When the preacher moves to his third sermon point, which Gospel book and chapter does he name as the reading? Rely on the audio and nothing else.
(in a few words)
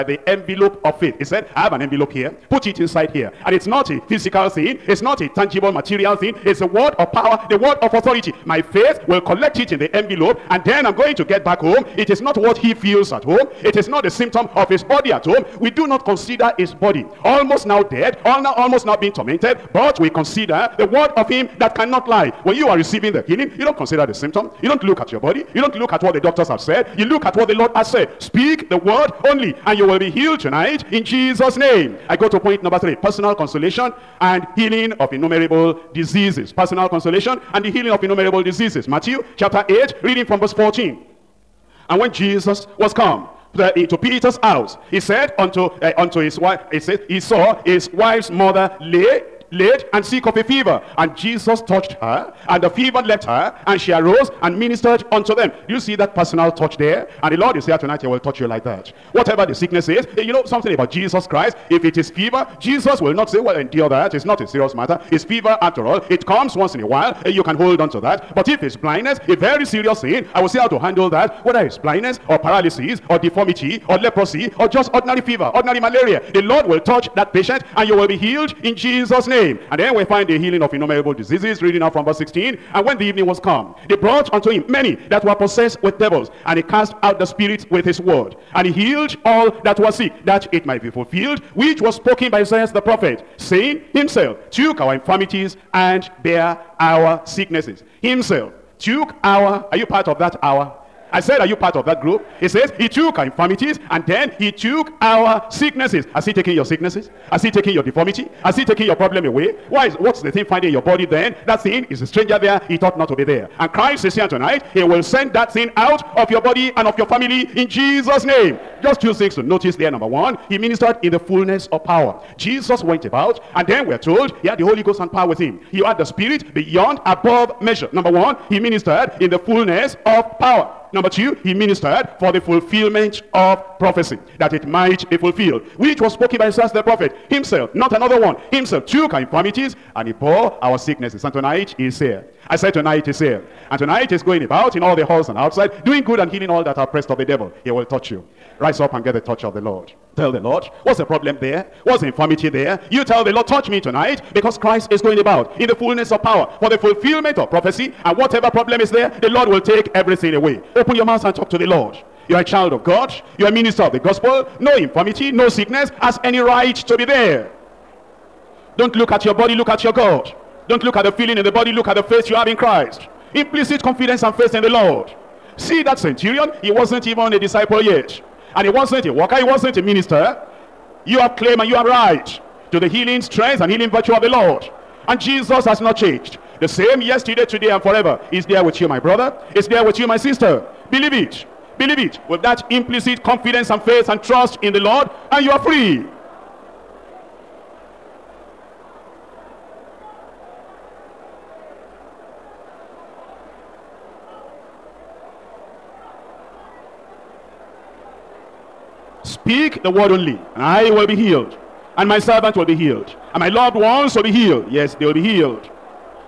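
Matthew 8.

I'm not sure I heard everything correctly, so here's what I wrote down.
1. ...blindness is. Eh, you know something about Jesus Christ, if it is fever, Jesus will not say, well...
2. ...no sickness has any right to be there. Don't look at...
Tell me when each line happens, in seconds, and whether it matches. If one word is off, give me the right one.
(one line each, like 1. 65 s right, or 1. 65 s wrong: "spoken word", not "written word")
1. 59 s wrong: "sickness", not "blindness"
2. 165 s right.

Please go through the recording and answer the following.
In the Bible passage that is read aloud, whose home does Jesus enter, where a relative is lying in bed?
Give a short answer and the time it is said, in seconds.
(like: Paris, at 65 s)
Peter's house, at 43 s.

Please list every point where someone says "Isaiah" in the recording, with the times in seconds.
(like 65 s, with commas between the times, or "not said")
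92 s, 136 s.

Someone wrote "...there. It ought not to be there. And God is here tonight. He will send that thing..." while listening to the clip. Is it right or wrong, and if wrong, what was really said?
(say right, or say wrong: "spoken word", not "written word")
wrong: "Christ", not "God".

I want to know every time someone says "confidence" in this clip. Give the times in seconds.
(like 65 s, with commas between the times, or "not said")
173 s, 193 s.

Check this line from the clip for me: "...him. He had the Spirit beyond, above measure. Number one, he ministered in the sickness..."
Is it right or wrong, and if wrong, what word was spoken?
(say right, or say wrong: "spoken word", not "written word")
wrong: "fullness", not "sickness".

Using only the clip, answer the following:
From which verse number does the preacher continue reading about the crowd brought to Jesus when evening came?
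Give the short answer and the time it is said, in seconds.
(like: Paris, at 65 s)
16, at 82 s.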